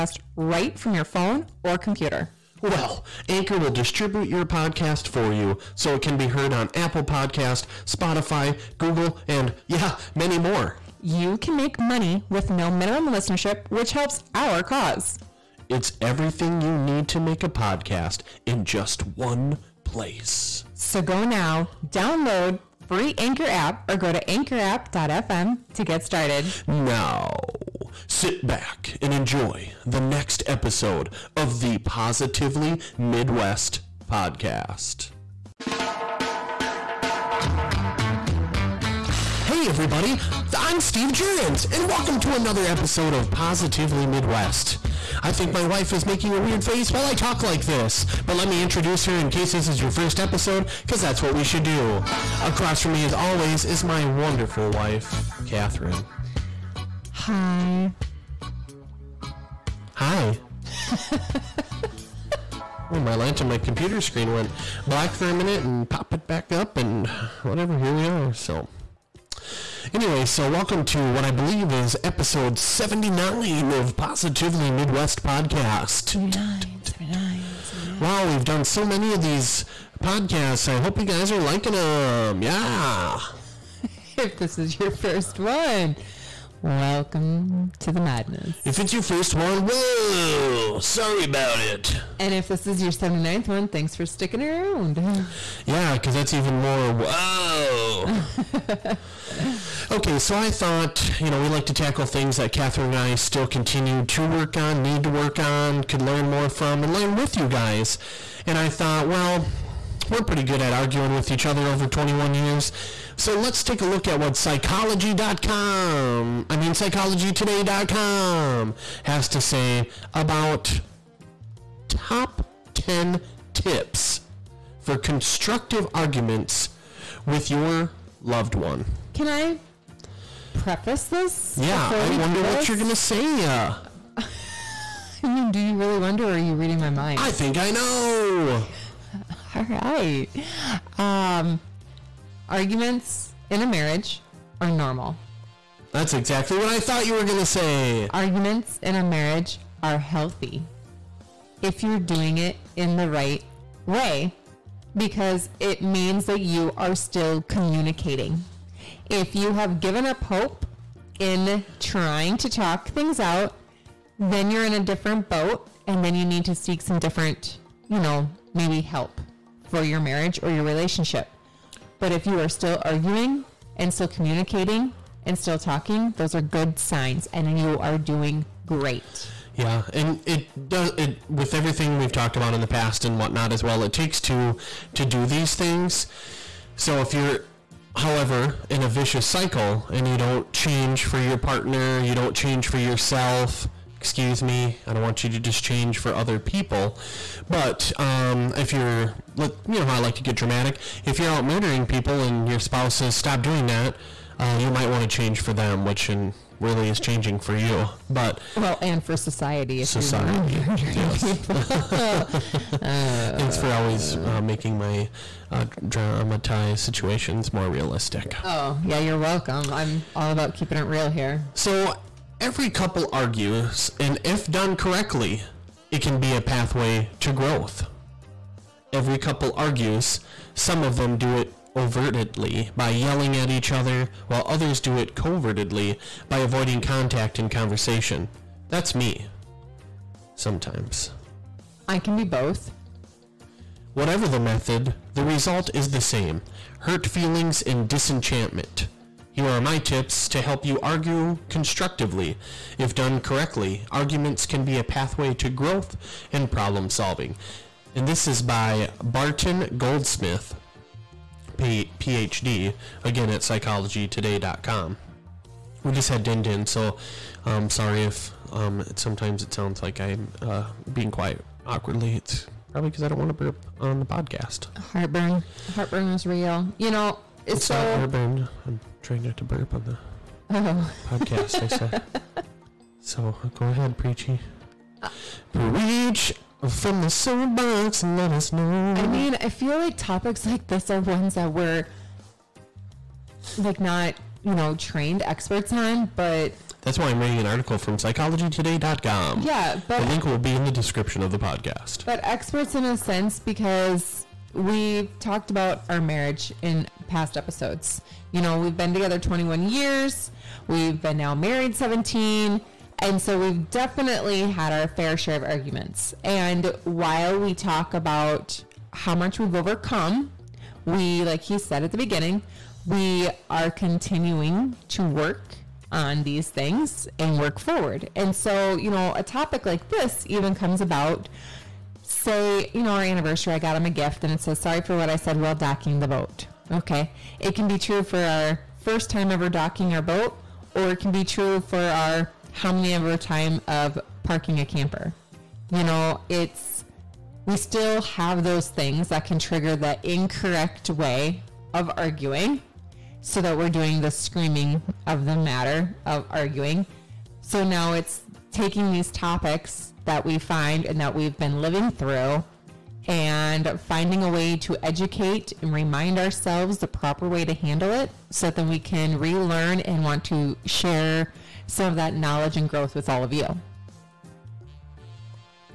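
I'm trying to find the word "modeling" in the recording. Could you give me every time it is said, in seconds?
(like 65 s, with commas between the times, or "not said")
not said.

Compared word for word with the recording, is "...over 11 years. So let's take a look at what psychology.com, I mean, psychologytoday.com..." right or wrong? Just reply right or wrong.
wrong.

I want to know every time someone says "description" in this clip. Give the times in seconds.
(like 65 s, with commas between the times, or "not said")
300 s.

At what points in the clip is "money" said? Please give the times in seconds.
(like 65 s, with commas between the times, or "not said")
11 s.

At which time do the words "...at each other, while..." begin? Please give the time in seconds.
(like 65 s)
233 s.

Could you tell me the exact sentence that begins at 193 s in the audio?
Excuse me, I don't want you to just change for other people.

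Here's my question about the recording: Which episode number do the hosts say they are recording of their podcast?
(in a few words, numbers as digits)
79.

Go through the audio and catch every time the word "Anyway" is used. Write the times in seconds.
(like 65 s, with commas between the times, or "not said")
69 s.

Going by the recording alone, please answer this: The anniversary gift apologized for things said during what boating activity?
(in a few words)
docking the boat.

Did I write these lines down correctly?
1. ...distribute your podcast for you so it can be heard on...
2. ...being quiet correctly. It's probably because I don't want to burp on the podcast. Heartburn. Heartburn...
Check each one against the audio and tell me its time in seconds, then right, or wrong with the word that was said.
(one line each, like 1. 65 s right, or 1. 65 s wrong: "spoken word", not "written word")
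1. 3 s right
2. 270 s wrong: "awkwardly", not "correctly".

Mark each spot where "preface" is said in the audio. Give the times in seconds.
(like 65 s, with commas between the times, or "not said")
130 s.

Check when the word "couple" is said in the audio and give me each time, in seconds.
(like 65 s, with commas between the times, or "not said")
222 s, 229 s.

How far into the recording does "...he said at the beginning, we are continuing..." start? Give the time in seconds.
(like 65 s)
321 s.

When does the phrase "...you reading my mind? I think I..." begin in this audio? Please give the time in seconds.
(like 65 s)
136 s.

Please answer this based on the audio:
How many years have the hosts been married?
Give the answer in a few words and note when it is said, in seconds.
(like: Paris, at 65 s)
17, at 311 s.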